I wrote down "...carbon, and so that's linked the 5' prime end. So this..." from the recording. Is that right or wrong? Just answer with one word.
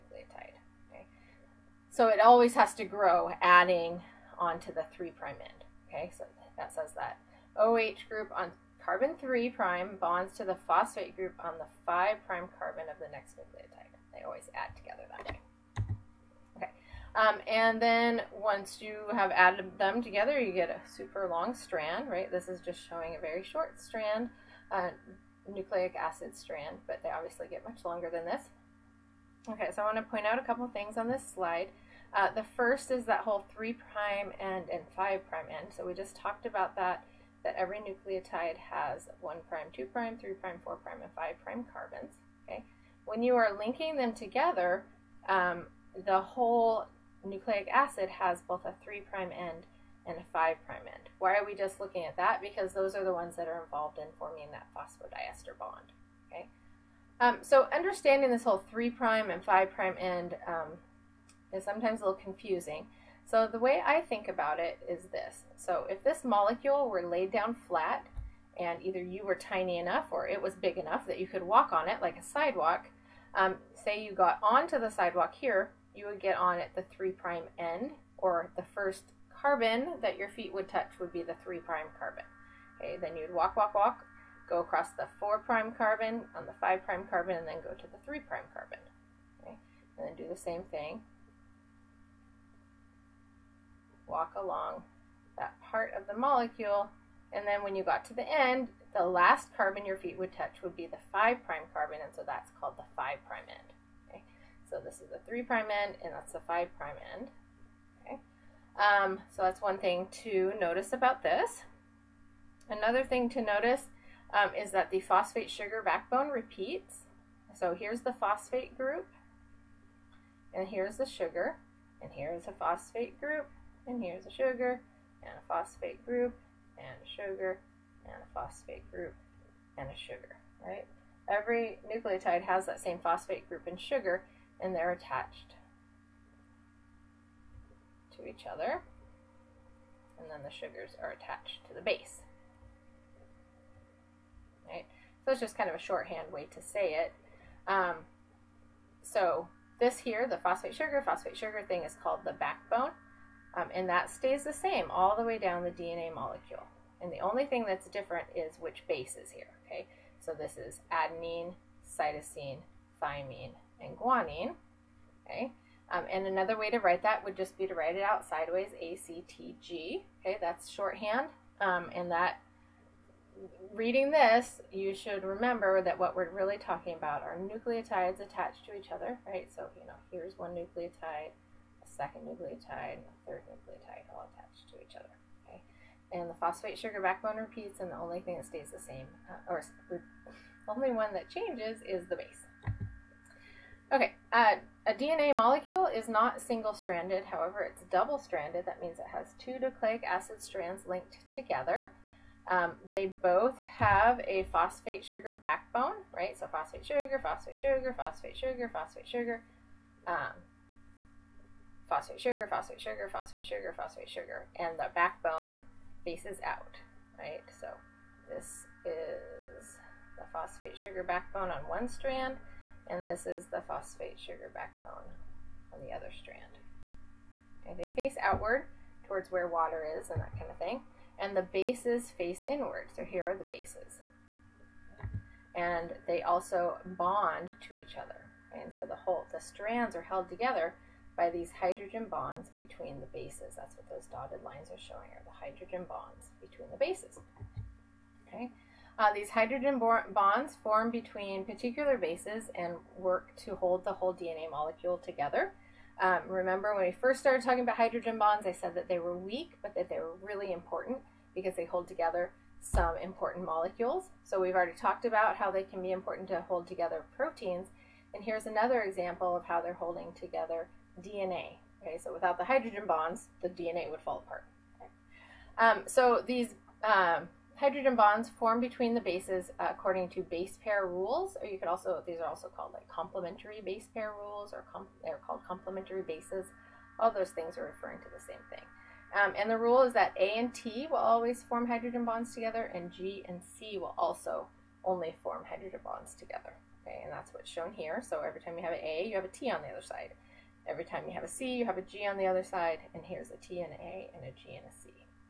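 wrong.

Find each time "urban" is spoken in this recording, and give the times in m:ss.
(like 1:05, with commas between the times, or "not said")
not said.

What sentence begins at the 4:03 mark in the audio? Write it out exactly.
That's what those dotted lines are showing are the hydrogen bonds between the bases.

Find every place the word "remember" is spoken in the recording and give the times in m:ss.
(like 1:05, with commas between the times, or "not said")
2:55, 4:16.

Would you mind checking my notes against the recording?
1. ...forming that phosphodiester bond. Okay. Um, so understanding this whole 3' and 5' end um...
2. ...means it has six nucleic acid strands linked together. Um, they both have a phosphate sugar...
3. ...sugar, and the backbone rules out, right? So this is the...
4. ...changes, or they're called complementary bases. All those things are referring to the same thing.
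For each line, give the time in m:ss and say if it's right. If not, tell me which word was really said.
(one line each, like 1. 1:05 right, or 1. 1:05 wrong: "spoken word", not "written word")
1. 0:54 right
2. 3:18 wrong: "two", not "six"
3. 3:34 wrong: "faces", not "rules"
4. 4:44 wrong: "rules", not "changes".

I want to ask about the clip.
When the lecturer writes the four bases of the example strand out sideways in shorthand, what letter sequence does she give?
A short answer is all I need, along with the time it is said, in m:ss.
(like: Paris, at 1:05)
ACTG, at 2:48.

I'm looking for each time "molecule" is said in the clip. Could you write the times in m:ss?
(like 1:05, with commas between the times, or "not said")
1:06, 1:36, 2:36, 3:15, 4:14, 4:23.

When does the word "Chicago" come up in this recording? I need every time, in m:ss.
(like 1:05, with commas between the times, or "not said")
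not said.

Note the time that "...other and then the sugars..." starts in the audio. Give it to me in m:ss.
2:18.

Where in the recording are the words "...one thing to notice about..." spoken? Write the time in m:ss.
1:49.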